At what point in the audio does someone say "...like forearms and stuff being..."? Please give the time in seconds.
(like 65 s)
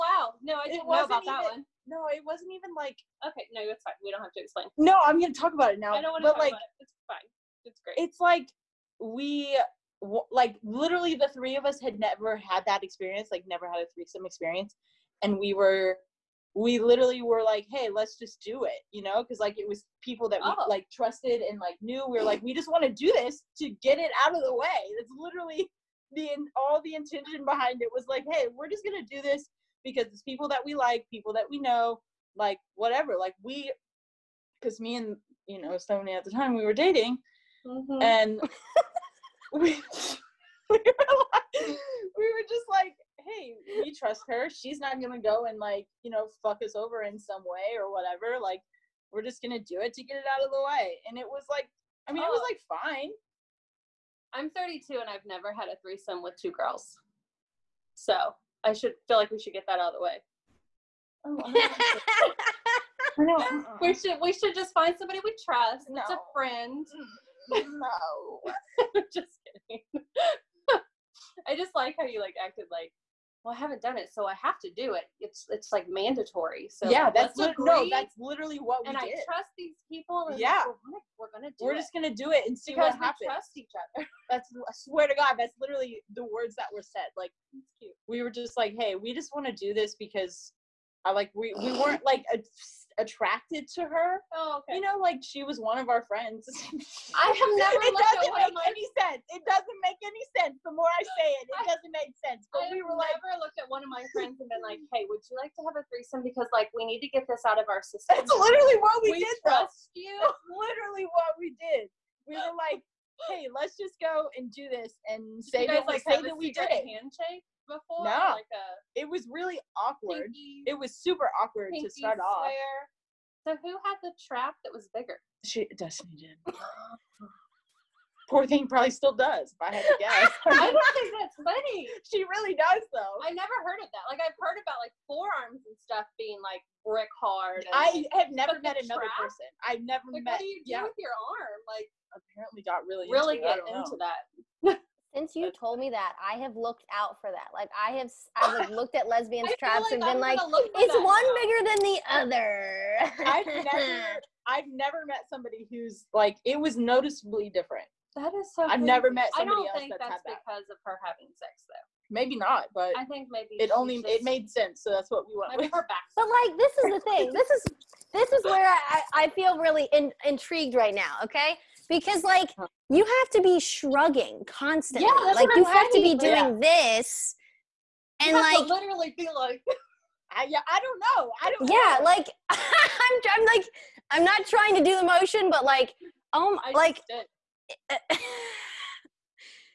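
134 s.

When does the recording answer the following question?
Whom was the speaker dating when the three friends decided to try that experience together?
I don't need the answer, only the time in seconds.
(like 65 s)
35 s.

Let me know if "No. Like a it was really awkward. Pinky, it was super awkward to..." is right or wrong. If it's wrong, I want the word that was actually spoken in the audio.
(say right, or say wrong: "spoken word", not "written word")
right.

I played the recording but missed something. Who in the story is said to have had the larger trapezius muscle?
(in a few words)
Destiny.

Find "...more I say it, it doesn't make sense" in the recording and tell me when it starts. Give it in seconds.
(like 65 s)
100 s.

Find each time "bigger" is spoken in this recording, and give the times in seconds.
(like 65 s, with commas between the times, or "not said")
124 s, 151 s.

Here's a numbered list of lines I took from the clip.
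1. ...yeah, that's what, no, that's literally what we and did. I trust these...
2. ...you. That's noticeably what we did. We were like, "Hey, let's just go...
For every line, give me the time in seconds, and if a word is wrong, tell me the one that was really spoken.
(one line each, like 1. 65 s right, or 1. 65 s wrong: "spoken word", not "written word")
1. 76 s right
2. 110 s wrong: "literally", not "noticeably".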